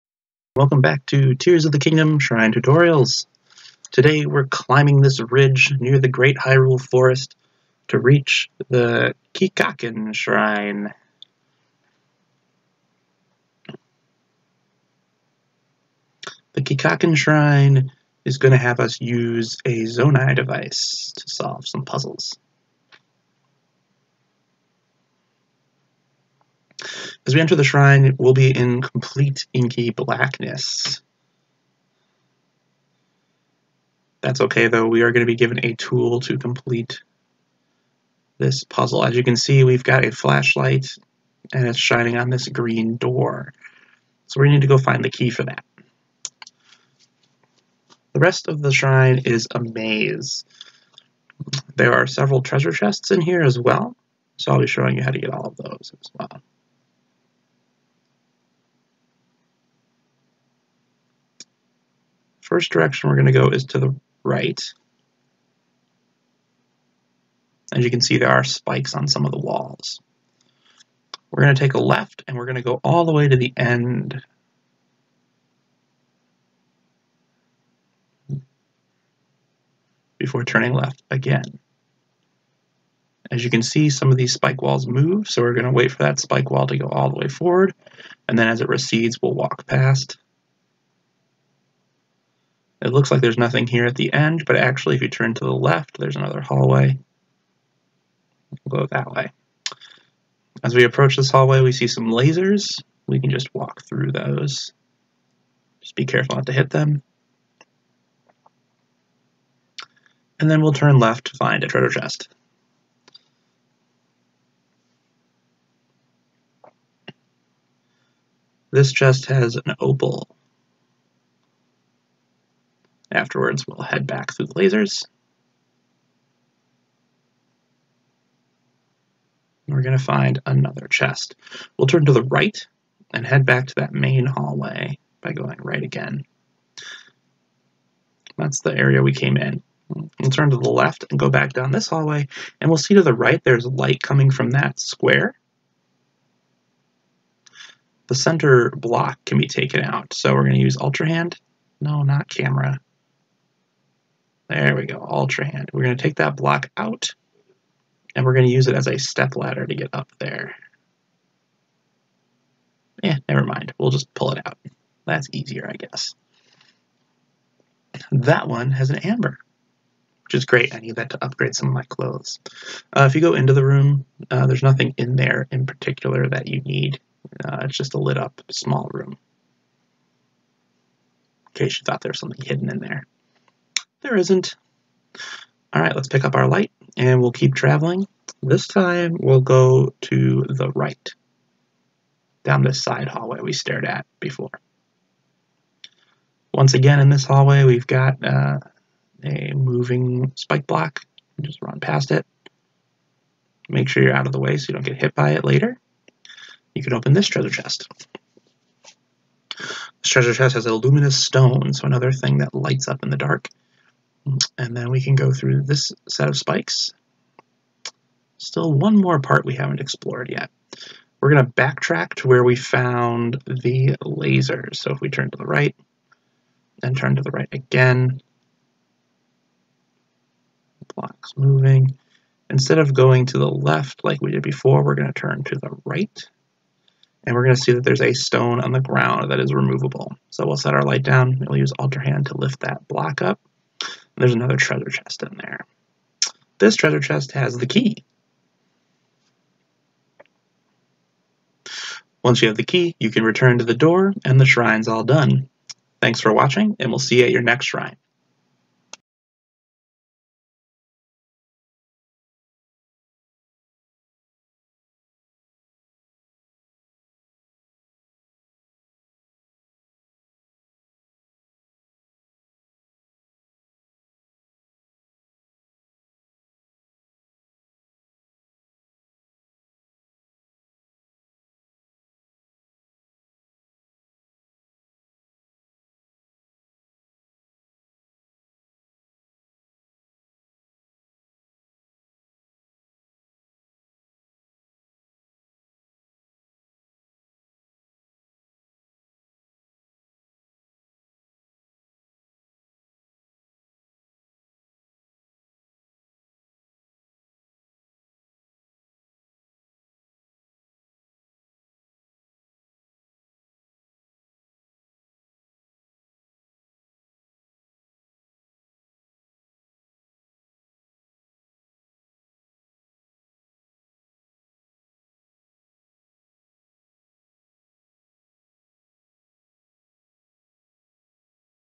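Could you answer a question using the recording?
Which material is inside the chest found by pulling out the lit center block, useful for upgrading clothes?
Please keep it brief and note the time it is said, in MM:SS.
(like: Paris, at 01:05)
Amber, at 02:48.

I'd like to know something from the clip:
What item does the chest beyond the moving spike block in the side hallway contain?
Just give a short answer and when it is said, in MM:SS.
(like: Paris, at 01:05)
Luminous stone, at 03:30.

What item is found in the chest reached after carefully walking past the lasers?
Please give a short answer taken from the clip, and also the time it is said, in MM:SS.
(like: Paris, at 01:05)
Opal, at 01:59.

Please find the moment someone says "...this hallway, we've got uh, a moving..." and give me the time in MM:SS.
03:17.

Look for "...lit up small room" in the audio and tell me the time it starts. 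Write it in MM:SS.
02:57.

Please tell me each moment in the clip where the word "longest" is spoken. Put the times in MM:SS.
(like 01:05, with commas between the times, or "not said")
not said.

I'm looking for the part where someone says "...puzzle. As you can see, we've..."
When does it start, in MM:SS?
00:38.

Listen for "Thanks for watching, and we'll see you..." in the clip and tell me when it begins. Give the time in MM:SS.
04:16.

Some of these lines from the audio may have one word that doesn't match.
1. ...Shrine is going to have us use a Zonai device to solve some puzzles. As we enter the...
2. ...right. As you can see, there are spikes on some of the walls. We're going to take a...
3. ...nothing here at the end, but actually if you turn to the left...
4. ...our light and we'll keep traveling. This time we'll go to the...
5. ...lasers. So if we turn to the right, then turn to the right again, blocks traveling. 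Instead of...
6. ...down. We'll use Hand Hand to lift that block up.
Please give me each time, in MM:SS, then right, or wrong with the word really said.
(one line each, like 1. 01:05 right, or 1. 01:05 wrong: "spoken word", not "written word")
1. 00:17 right
2. 01:04 right
3. 01:33 right
4. 03:06 right
5. 03:44 wrong: "moving", not "traveling"
6. 04:01 wrong: "Ultra", not "Hand".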